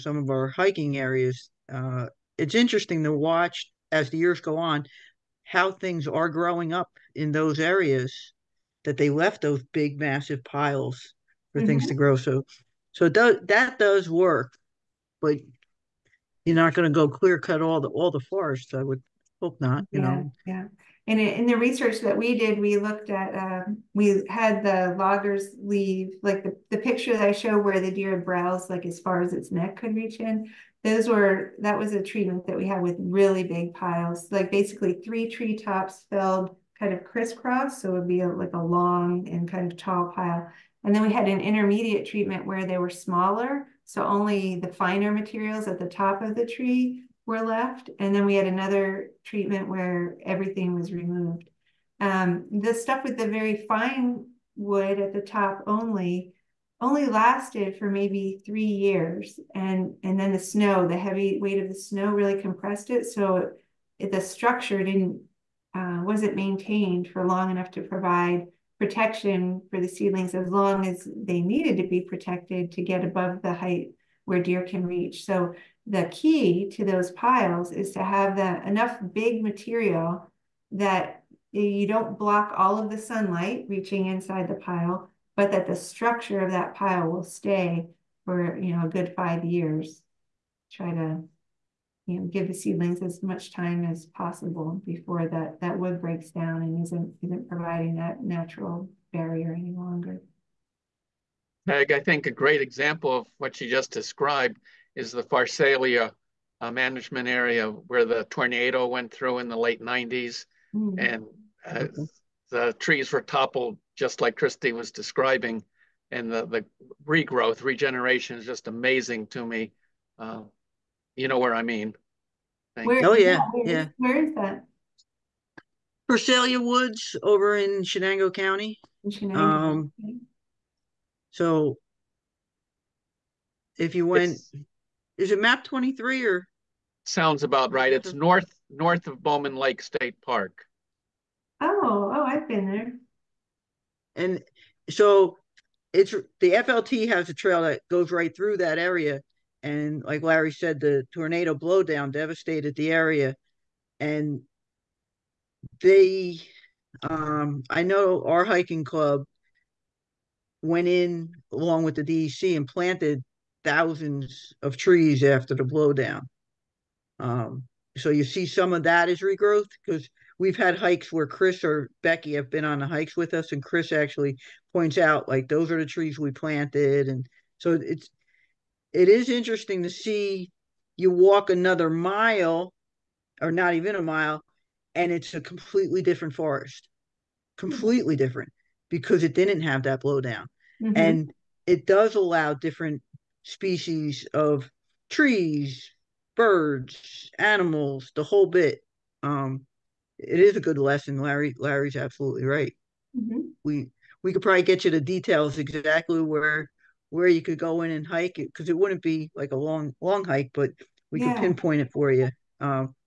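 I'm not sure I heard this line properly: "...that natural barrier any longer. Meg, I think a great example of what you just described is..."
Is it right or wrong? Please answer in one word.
right.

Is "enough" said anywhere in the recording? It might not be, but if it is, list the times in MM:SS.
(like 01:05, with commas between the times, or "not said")
01:07, 01:18.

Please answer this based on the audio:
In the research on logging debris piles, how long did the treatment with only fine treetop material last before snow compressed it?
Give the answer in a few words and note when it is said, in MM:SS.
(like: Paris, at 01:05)
3 years, at 00:58.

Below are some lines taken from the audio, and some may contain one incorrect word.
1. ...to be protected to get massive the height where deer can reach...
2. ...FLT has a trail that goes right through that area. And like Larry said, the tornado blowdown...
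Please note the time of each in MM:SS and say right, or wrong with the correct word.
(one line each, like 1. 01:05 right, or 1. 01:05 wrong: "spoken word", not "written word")
1. 01:11 wrong: "above", not "massive"
2. 02:26 right.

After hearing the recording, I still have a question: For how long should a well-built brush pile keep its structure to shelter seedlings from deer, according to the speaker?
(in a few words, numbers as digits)
5 years.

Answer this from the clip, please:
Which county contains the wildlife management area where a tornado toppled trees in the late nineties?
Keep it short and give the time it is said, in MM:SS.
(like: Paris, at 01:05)
Chenango County, at 02:07.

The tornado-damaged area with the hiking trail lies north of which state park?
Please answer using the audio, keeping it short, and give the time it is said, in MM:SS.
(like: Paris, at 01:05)
Bowman Lake State Park, at 02:19.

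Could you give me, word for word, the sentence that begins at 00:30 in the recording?
Those were, that was a treatment that we had with really big piles, like basically three treetops filled kind of crisscross.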